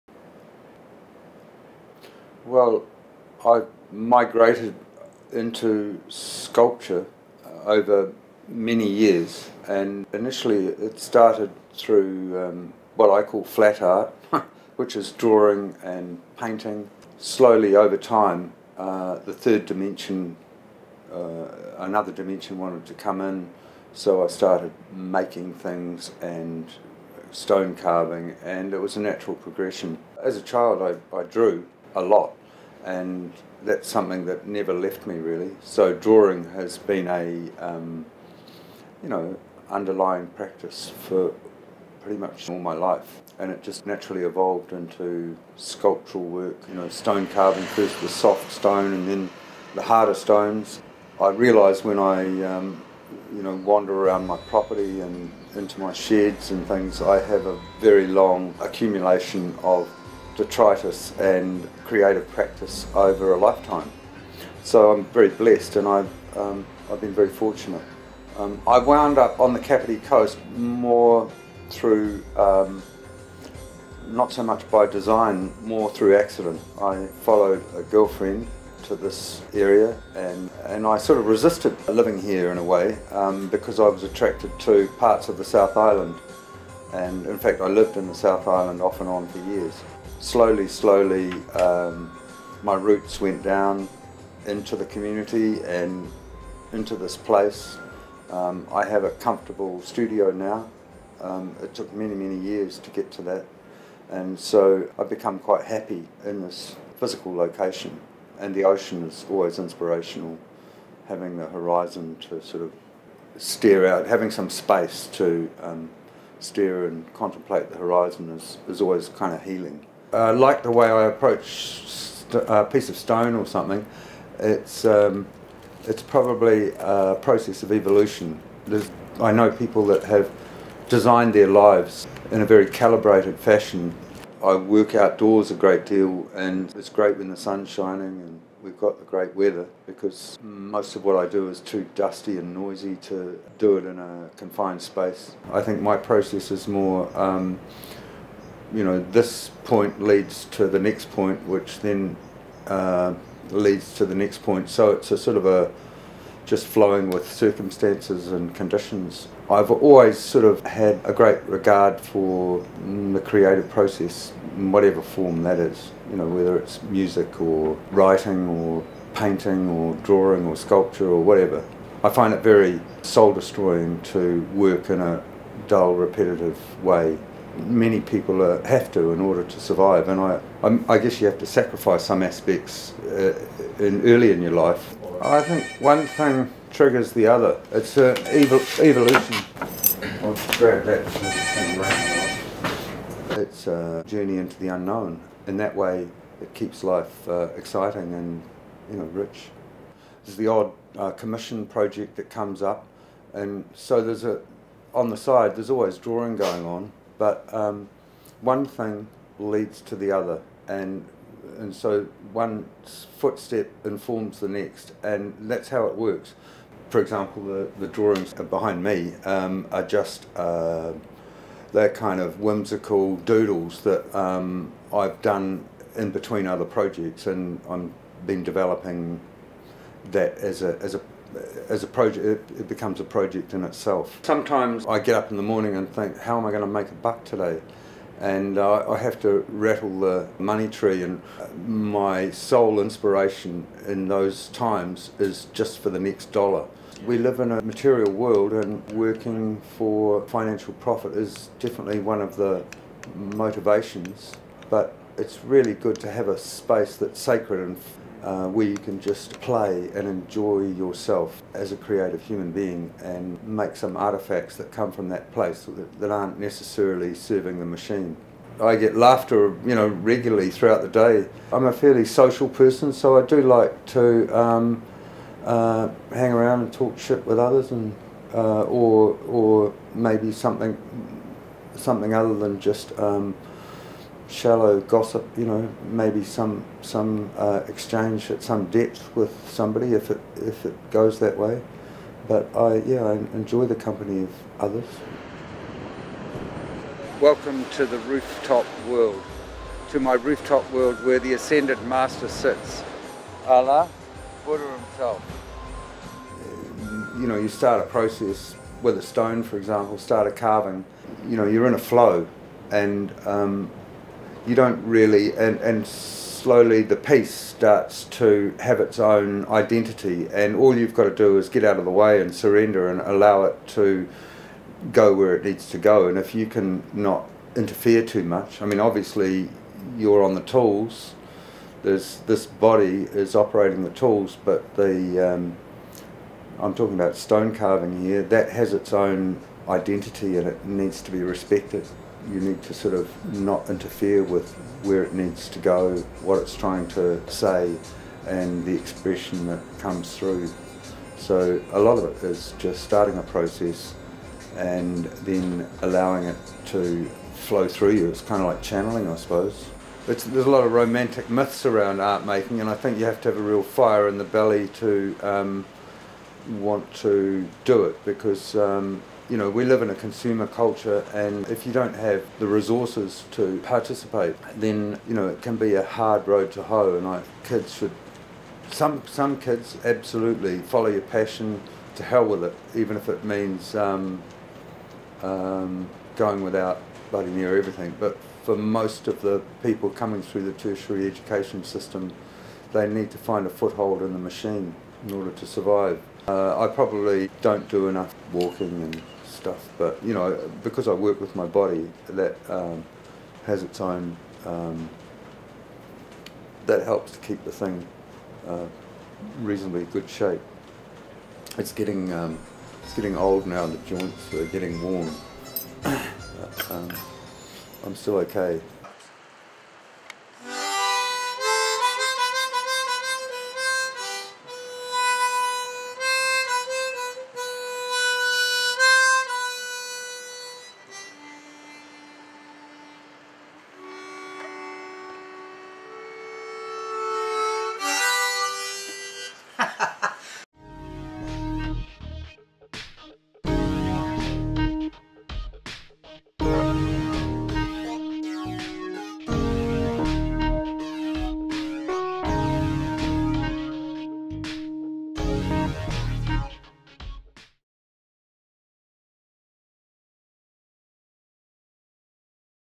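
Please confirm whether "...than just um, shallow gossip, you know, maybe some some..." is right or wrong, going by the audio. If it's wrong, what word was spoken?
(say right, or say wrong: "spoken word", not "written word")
right.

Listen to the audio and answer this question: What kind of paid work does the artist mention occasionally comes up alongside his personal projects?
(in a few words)
commission project.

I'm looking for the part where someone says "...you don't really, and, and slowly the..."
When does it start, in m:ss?
5:14.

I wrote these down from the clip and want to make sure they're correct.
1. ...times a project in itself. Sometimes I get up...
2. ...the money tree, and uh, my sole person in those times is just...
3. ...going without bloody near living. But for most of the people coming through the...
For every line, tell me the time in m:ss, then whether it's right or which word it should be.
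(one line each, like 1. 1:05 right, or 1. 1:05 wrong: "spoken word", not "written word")
1. 3:52 wrong: "becomes", not "times"
2. 3:59 wrong: "inspiration", not "person"
3. 6:26 wrong: "everything", not "living".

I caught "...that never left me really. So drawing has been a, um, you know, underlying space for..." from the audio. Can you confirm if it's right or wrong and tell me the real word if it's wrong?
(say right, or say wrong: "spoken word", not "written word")
wrong: "practice", not "space".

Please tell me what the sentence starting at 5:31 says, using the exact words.
There's this body is operating the tools, but the um, I'm talking about stone carving here.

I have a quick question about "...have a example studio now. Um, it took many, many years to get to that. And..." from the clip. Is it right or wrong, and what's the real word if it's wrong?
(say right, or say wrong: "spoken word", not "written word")
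wrong: "comfortable", not "example".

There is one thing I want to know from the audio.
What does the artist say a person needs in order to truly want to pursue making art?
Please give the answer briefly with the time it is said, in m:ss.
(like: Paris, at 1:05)
fire in the belly, at 6:03.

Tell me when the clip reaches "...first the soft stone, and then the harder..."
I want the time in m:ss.
0:47.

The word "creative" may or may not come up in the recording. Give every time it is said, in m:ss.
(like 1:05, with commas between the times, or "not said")
1:01, 2:43, 4:21.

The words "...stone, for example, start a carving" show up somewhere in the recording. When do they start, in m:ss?
5:09.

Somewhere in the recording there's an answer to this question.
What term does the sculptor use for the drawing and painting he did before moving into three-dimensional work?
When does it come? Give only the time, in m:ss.
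0:13.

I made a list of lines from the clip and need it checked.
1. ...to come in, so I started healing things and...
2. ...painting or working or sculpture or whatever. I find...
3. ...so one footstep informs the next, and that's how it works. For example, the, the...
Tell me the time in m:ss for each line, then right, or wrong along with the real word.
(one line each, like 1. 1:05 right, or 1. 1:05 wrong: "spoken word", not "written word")
1. 0:22 wrong: "making", not "healing"
2. 2:49 wrong: "drawing", not "working"
3. 3:31 right.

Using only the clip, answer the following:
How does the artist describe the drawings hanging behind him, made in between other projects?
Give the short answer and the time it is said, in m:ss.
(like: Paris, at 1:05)
whimsical doodles, at 3:42.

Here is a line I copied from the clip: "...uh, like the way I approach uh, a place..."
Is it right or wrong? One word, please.
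wrong.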